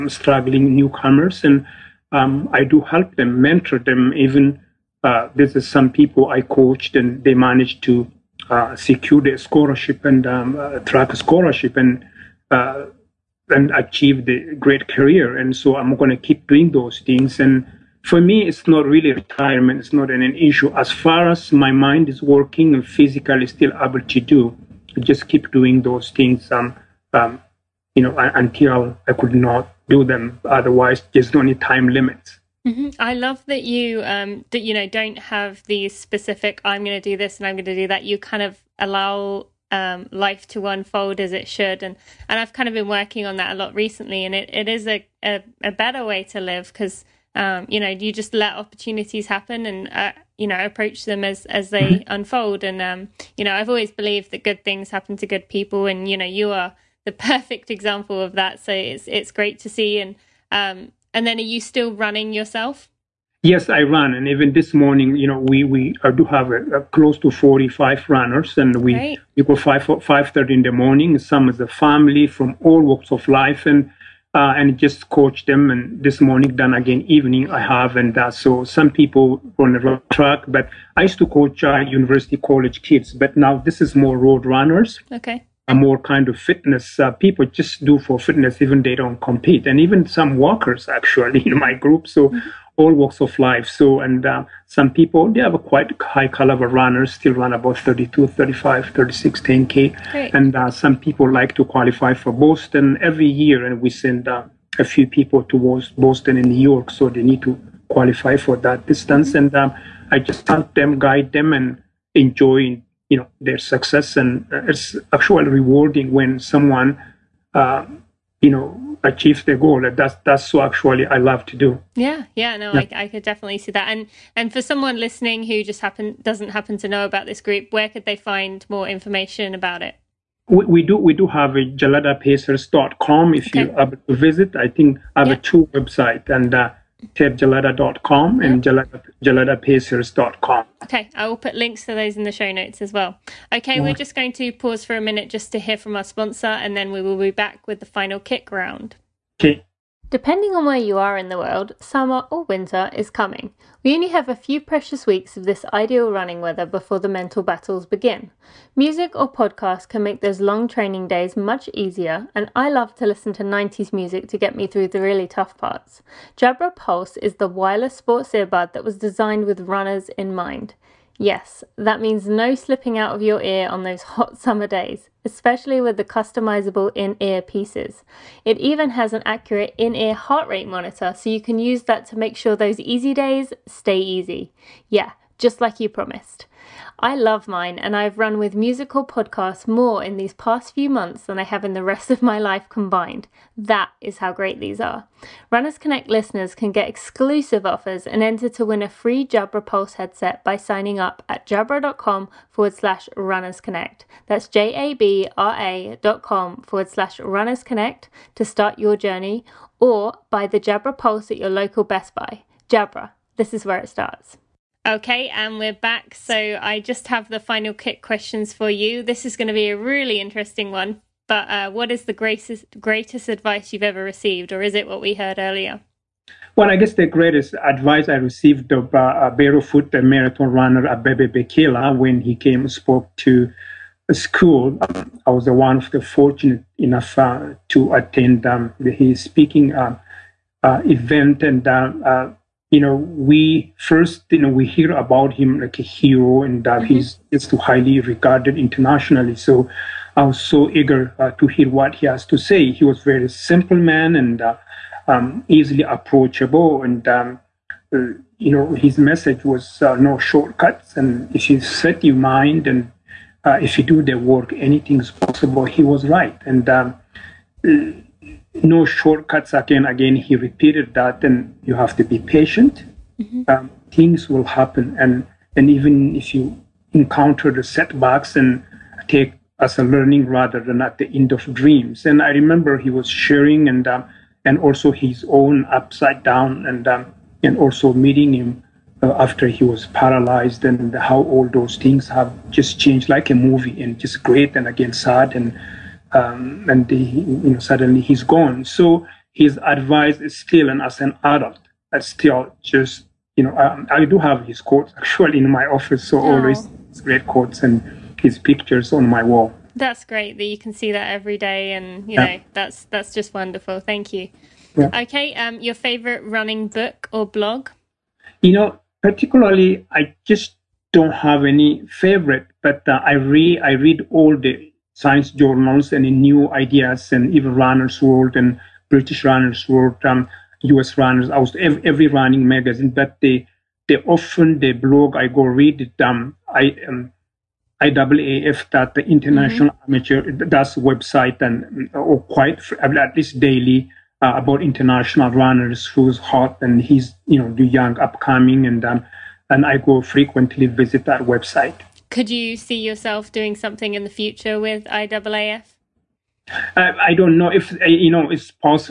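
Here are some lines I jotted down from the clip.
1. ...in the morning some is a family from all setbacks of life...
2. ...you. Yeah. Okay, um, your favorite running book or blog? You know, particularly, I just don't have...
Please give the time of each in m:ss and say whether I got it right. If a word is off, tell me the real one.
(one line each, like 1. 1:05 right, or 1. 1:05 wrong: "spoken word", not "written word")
1. 1:10 wrong: "walks", not "setbacks"
2. 5:14 right.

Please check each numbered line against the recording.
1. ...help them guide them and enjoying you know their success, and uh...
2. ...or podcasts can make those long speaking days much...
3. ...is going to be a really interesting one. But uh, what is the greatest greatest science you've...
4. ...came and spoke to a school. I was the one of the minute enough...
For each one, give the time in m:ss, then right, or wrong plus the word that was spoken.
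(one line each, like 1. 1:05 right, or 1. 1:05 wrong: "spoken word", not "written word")
1. 1:50 right
2. 2:39 wrong: "training", not "speaking"
3. 3:39 wrong: "advice", not "science"
4. 3:52 wrong: "fortunate", not "minute".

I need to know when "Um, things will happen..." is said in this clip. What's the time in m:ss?
4:33.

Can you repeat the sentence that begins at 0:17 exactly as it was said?
And for me, it's not really retirement.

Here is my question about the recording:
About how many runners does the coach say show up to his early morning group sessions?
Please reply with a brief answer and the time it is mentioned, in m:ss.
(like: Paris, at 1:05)
45, at 1:07.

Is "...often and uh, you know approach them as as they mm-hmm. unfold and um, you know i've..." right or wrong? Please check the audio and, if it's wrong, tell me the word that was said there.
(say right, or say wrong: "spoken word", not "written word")
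wrong: "happen", not "often".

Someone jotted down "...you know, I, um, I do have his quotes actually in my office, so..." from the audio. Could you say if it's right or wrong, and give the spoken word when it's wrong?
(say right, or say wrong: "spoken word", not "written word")
right.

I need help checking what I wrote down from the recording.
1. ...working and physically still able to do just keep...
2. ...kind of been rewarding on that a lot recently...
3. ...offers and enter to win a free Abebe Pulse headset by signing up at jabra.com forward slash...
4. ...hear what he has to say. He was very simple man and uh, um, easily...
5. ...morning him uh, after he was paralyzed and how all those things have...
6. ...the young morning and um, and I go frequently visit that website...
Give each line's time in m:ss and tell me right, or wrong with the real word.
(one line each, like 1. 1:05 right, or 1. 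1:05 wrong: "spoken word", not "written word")
1. 0:22 right
2. 0:42 wrong: "working", not "rewarding"
3. 3:17 wrong: "Jabra", not "Abebe"
4. 4:11 right
5. 4:47 wrong: "meeting", not "morning"
6. 5:47 wrong: "upcoming", not "morning".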